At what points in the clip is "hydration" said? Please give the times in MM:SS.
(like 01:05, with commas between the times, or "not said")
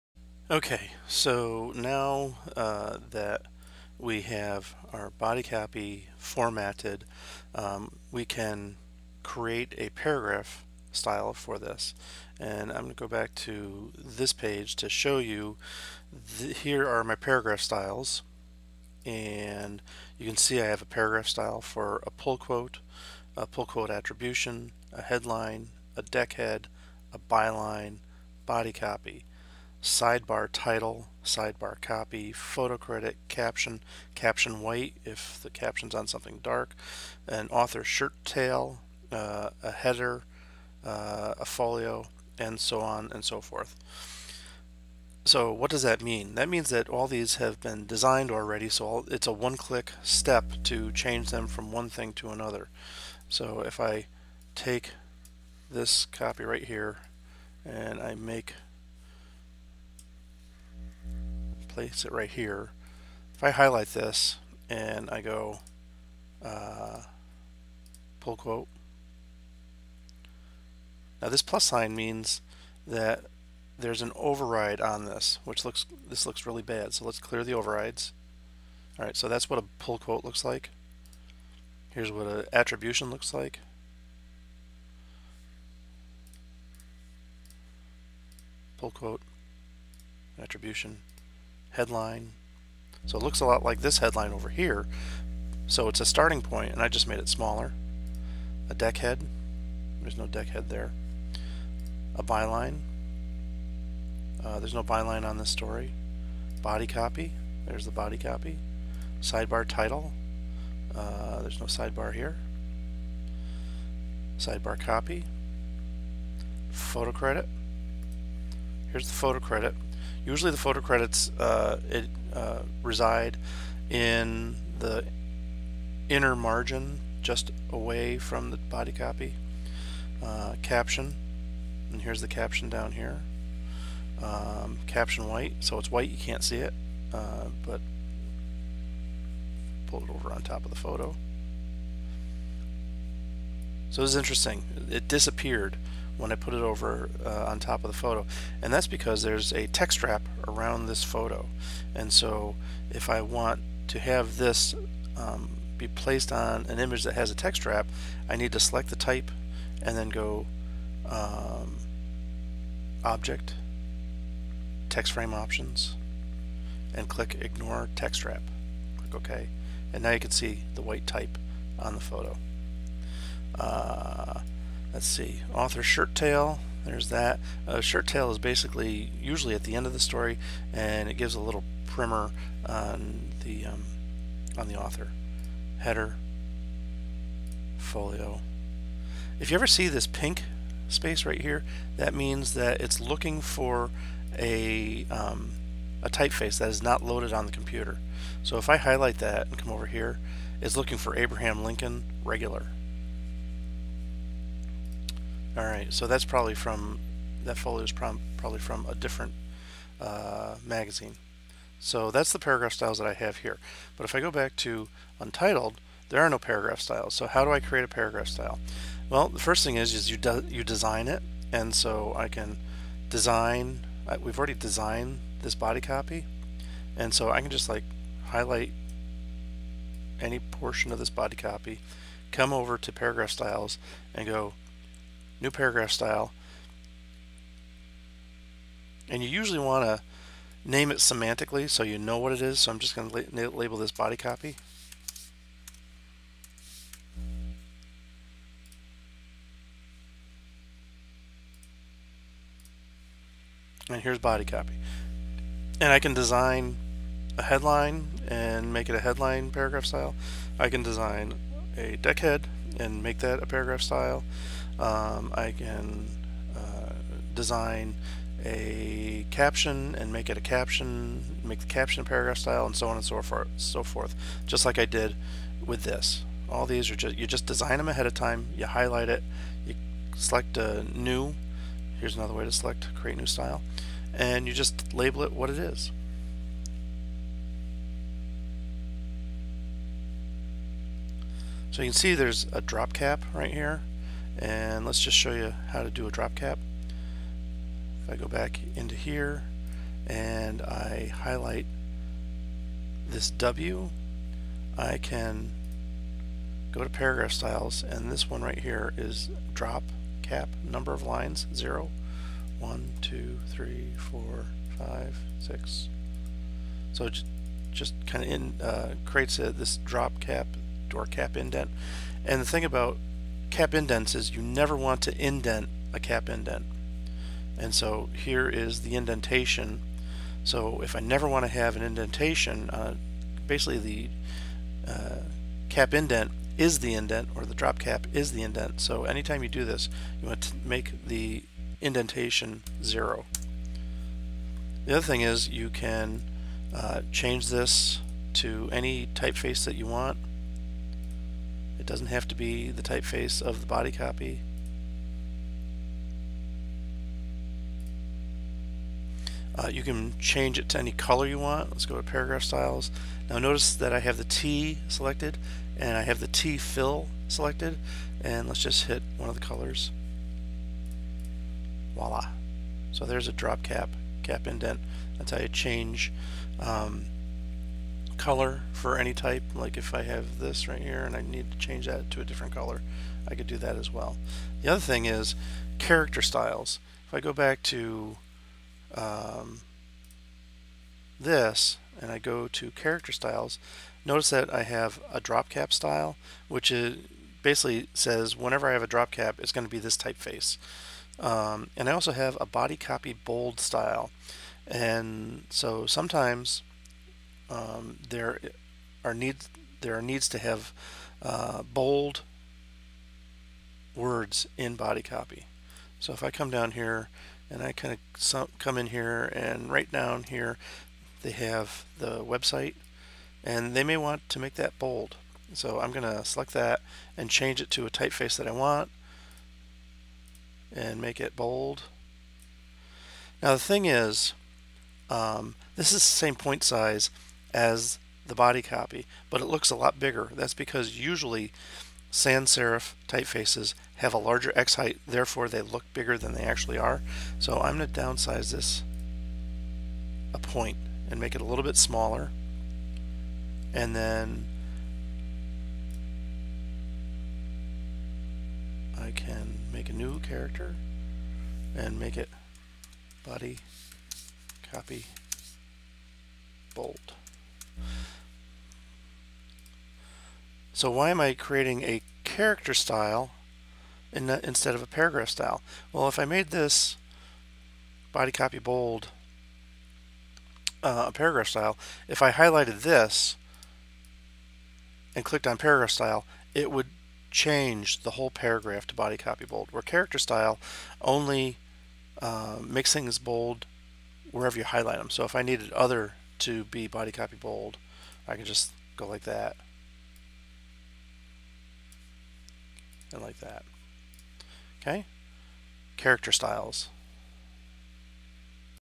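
not said.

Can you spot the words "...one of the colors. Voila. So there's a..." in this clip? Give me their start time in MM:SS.
06:09.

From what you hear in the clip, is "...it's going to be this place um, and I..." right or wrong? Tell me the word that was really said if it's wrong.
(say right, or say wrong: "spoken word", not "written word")
wrong: "typeface", not "place".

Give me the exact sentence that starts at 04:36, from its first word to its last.
All these are just you just design them ahead of time.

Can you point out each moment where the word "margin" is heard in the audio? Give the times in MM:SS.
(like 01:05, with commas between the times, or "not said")
02:06.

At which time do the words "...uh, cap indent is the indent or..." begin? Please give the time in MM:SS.
05:34.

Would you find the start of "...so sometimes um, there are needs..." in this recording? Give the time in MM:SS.
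06:45.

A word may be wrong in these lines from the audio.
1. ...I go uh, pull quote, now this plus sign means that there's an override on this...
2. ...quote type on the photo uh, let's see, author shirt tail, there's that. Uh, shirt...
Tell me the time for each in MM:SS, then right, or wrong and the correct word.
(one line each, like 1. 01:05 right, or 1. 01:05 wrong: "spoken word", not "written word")
1. 01:05 right
2. 02:50 wrong: "white", not "quote".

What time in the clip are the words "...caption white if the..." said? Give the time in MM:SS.
00:34.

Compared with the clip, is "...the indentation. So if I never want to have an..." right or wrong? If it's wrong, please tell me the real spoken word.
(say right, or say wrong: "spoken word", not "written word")
right.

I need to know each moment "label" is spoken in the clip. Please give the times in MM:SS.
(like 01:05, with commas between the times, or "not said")
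04:03, 04:44.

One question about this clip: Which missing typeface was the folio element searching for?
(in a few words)
Abraham Lincoln regular.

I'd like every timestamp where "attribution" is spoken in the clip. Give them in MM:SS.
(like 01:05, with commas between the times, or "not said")
00:23, 01:22, 01:30.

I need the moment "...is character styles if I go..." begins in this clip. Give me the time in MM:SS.
06:25.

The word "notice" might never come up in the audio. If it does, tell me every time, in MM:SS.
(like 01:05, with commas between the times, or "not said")
06:03, 06:34.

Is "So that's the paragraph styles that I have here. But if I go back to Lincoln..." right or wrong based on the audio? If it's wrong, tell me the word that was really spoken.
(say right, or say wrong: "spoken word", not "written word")
wrong: "Untitled", not "Lincoln".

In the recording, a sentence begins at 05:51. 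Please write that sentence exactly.
It doesn't have to be the typeface of the body copy.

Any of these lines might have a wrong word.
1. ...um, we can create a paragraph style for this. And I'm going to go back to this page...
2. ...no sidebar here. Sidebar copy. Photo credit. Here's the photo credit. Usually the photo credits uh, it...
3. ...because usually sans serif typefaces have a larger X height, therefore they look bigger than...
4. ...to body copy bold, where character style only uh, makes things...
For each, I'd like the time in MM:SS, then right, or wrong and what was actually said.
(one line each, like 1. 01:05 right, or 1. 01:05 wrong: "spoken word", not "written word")
1. 00:07 right
2. 01:51 right
3. 07:20 right
4. 08:08 right.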